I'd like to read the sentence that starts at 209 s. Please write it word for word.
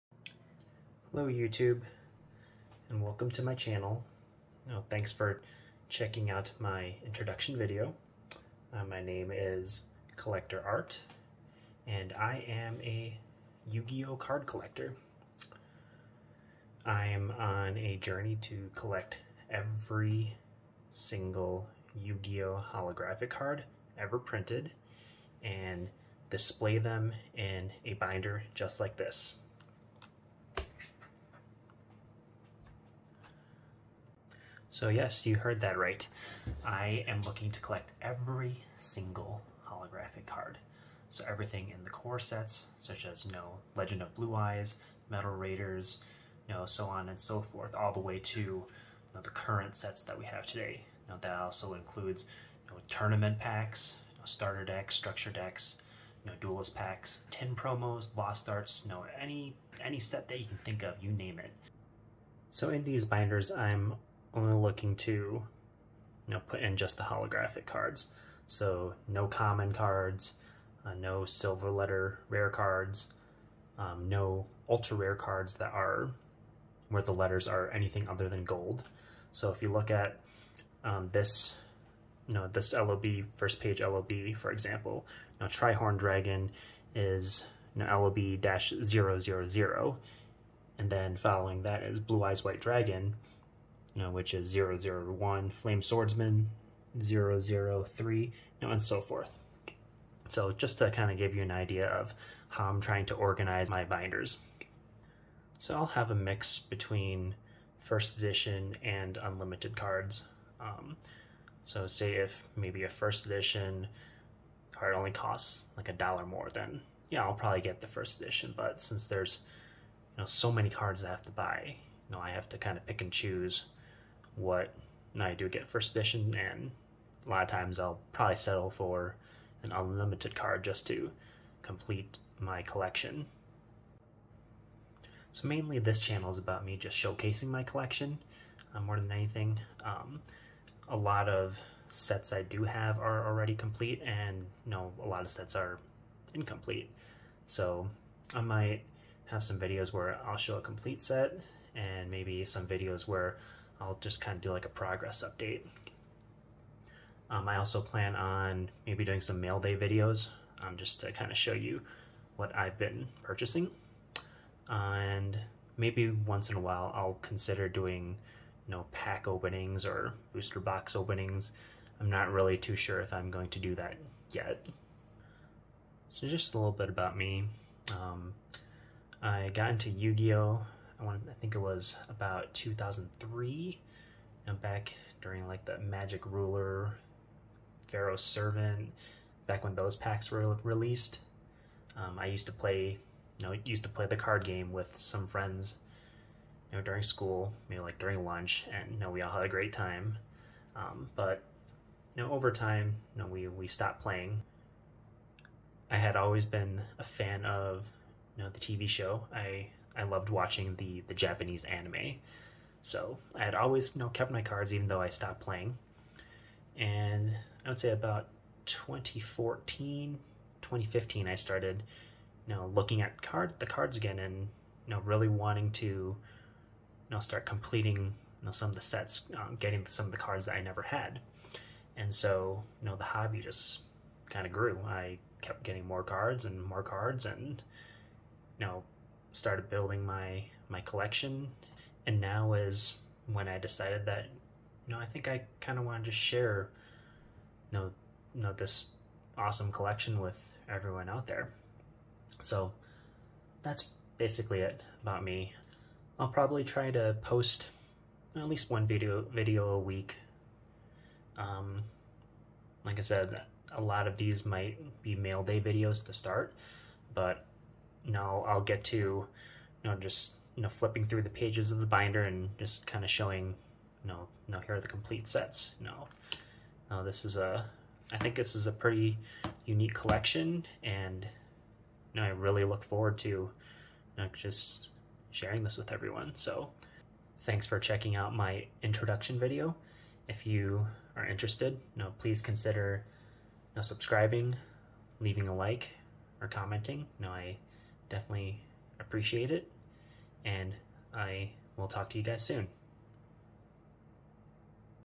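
I I loved watching the the Japanese anime.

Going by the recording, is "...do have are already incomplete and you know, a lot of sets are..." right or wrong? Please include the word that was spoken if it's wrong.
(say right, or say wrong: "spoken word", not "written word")
wrong: "complete", not "incomplete".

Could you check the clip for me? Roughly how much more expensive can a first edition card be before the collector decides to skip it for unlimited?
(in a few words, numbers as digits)
a dollar.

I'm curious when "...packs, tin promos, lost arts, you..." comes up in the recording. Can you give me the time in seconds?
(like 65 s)
56 s.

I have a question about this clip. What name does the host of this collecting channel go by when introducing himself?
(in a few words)
Collector Art.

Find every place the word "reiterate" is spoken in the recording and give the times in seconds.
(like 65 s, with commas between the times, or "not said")
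not said.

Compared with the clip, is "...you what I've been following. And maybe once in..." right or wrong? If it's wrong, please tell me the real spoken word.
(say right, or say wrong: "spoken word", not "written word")
wrong: "purchasing", not "following".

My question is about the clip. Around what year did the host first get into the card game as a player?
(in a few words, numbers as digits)
2003.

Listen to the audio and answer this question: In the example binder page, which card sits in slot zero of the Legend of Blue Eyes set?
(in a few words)
Trihorn Dragon.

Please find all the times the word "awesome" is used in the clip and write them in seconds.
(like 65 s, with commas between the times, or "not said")
249 s.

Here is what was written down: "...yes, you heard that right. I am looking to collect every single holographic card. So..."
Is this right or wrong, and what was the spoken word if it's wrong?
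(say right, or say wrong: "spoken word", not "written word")
right.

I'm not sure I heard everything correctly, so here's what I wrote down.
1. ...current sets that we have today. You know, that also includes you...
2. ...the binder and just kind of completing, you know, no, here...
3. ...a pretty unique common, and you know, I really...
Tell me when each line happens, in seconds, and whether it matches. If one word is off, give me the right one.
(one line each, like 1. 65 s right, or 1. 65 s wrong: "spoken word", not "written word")
1. 49 s right
2. 271 s wrong: "showing", not "completing"
3. 278 s wrong: "collection", not "common".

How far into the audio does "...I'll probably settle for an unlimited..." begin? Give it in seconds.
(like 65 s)
127 s.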